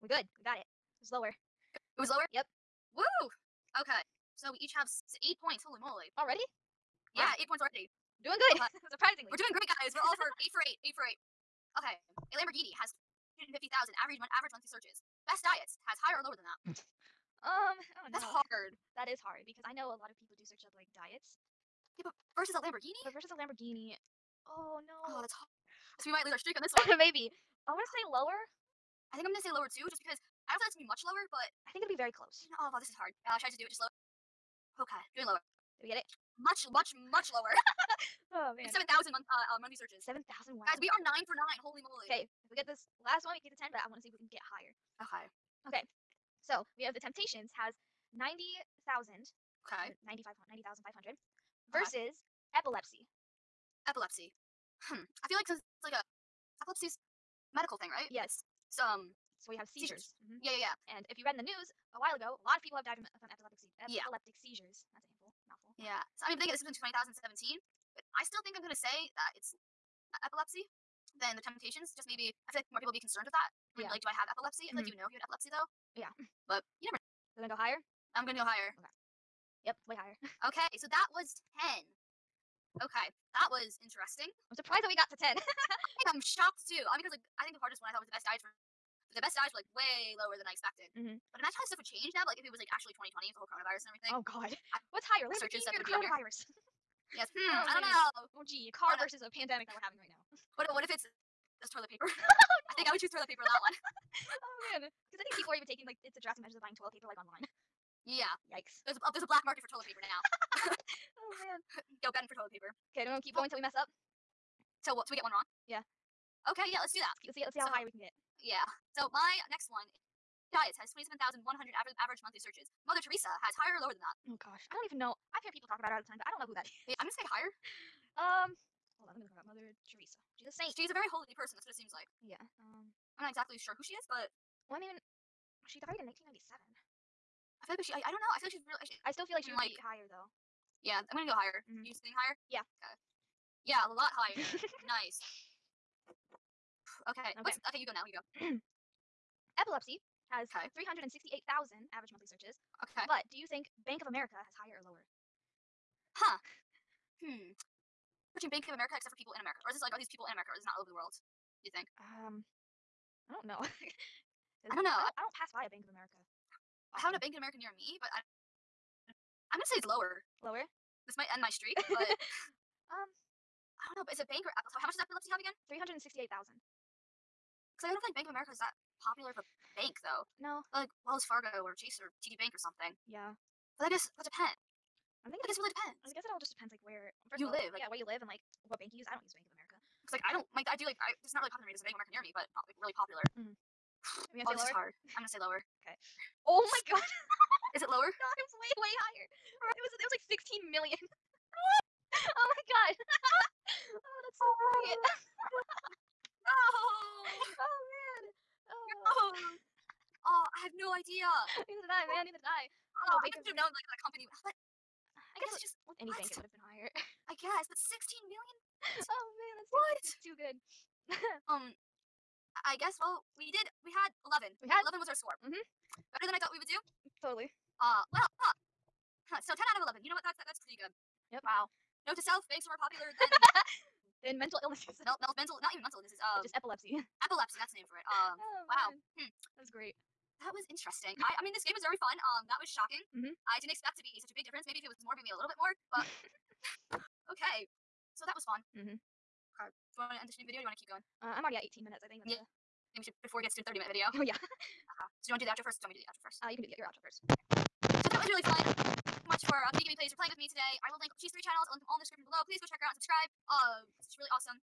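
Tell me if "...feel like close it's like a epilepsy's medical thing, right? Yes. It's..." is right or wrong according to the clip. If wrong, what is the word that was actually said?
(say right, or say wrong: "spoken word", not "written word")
wrong: "cause", not "close".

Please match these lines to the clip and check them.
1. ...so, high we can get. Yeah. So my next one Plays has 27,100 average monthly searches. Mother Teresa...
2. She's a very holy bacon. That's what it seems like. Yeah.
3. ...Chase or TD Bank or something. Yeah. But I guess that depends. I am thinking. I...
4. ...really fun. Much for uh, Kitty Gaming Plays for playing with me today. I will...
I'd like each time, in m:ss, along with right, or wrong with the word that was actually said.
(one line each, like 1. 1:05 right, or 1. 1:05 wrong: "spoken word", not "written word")
1. 1:57 wrong: "Diets", not "Plays"
2. 2:10 wrong: "person", not "bacon"
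3. 3:01 right
4. 4:18 right.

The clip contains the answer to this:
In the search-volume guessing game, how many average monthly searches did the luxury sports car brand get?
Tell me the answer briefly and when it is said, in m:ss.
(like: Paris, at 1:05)
250,000, at 0:13.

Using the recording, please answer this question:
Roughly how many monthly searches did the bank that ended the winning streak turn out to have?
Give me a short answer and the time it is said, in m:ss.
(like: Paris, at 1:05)
16 million, at 3:20.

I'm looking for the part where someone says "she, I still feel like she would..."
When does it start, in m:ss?
2:18.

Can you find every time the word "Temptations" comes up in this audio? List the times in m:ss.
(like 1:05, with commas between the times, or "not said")
0:46, 1:11.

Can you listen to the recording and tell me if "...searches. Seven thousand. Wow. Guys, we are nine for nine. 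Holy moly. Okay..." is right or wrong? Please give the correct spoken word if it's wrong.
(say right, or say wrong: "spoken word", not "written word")
right.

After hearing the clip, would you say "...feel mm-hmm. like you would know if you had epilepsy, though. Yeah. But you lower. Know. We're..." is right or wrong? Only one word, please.
wrong.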